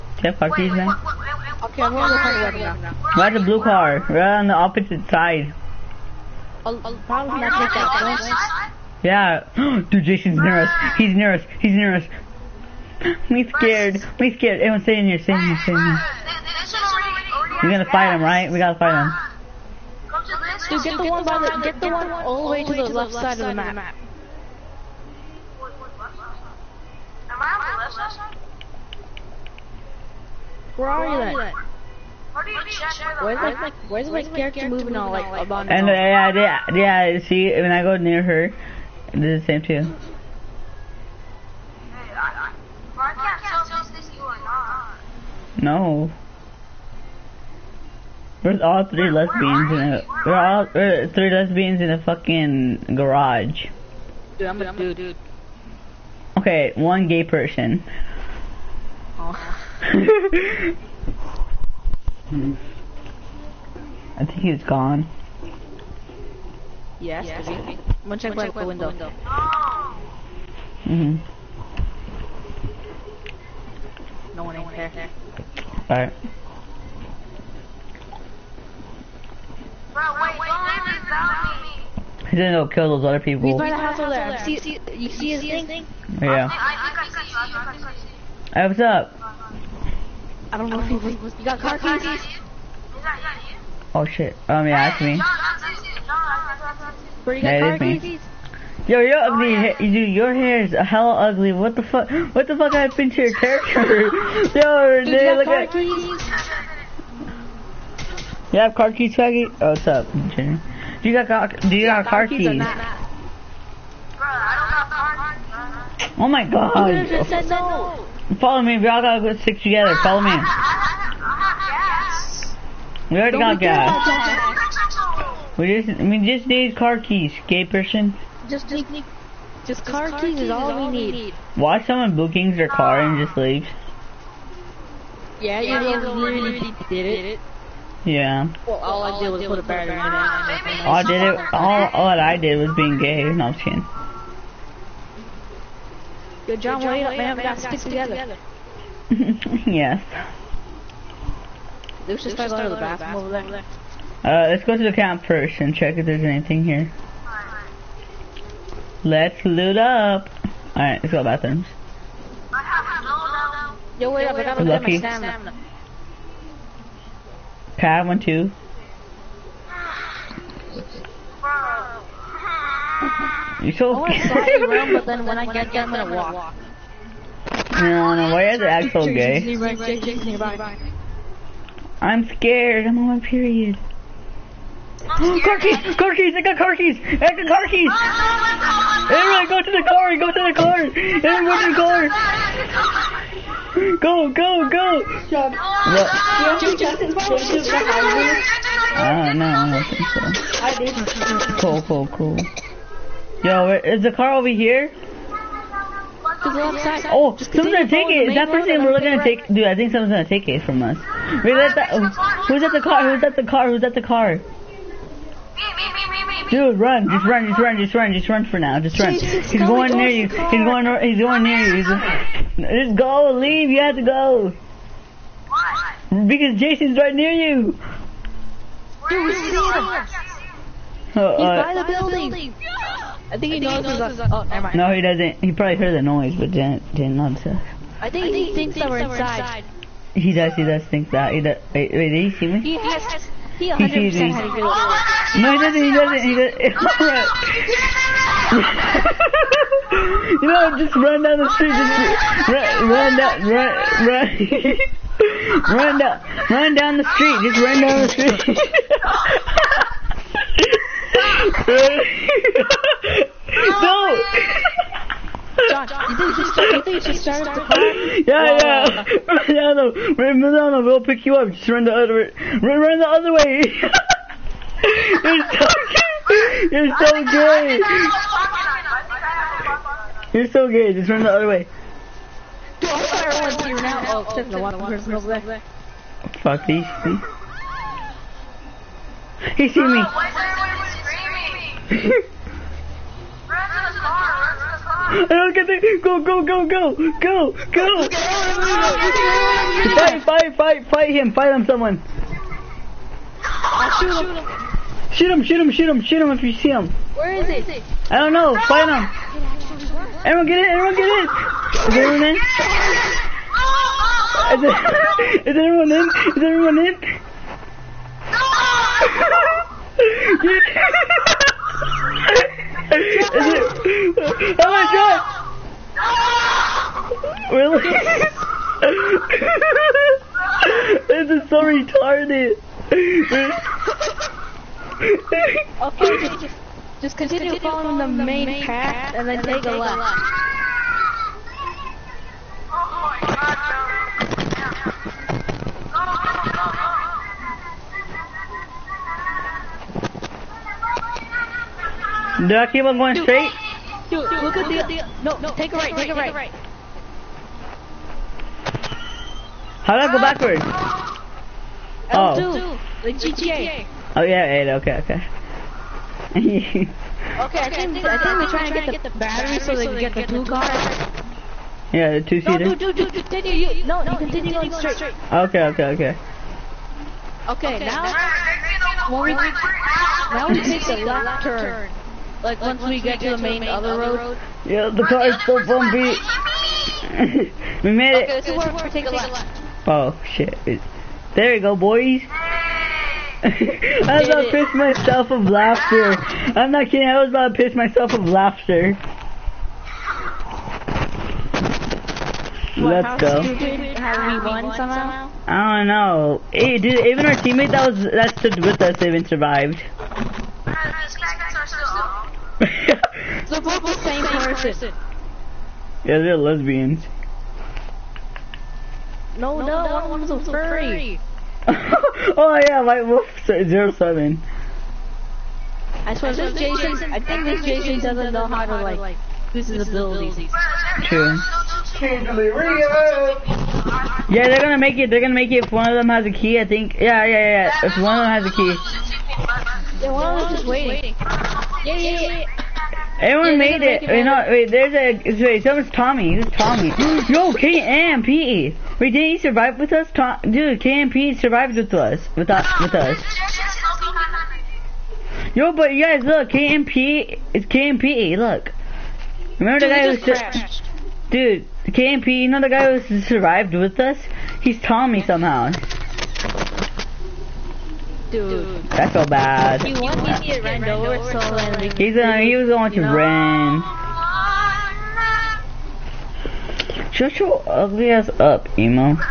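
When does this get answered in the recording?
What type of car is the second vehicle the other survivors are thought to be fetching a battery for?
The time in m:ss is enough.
6:12.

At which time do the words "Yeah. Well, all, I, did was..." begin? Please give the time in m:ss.
2:18.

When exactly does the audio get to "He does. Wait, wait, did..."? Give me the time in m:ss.
4:01.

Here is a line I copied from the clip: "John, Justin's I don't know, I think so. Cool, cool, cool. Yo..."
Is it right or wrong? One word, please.
right.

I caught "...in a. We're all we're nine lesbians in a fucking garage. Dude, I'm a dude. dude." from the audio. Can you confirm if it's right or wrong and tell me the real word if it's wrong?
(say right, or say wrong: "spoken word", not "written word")
wrong: "three", not "nine".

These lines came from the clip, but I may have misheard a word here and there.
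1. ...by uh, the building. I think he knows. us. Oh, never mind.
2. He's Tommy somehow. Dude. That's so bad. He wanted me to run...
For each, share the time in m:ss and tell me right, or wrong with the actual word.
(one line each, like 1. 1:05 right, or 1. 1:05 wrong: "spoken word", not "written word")
1. 3:51 right
2. 7:44 right.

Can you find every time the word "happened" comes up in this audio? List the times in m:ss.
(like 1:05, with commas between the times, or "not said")
1:42.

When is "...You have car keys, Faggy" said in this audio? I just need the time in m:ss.
1:48.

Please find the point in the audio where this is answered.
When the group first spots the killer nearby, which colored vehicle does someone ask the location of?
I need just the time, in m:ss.
0:03.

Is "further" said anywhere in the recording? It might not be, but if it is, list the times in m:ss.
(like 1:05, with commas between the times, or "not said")
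not said.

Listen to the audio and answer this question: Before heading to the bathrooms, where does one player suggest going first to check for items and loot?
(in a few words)
The camp.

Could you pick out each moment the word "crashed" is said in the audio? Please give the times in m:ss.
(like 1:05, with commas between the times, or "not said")
7:40.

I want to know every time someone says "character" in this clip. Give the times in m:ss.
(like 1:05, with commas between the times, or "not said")
0:34, 1:43.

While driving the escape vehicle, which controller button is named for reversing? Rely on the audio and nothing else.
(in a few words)
L2.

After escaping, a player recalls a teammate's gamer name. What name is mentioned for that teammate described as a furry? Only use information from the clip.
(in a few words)
Wolf 07.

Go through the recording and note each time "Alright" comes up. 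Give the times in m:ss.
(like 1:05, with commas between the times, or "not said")
1:15, 2:40.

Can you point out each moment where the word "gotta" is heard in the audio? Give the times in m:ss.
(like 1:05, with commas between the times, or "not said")
0:18, 1:59, 2:27, 2:44.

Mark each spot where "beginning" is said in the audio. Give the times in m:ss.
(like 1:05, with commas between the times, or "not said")
not said.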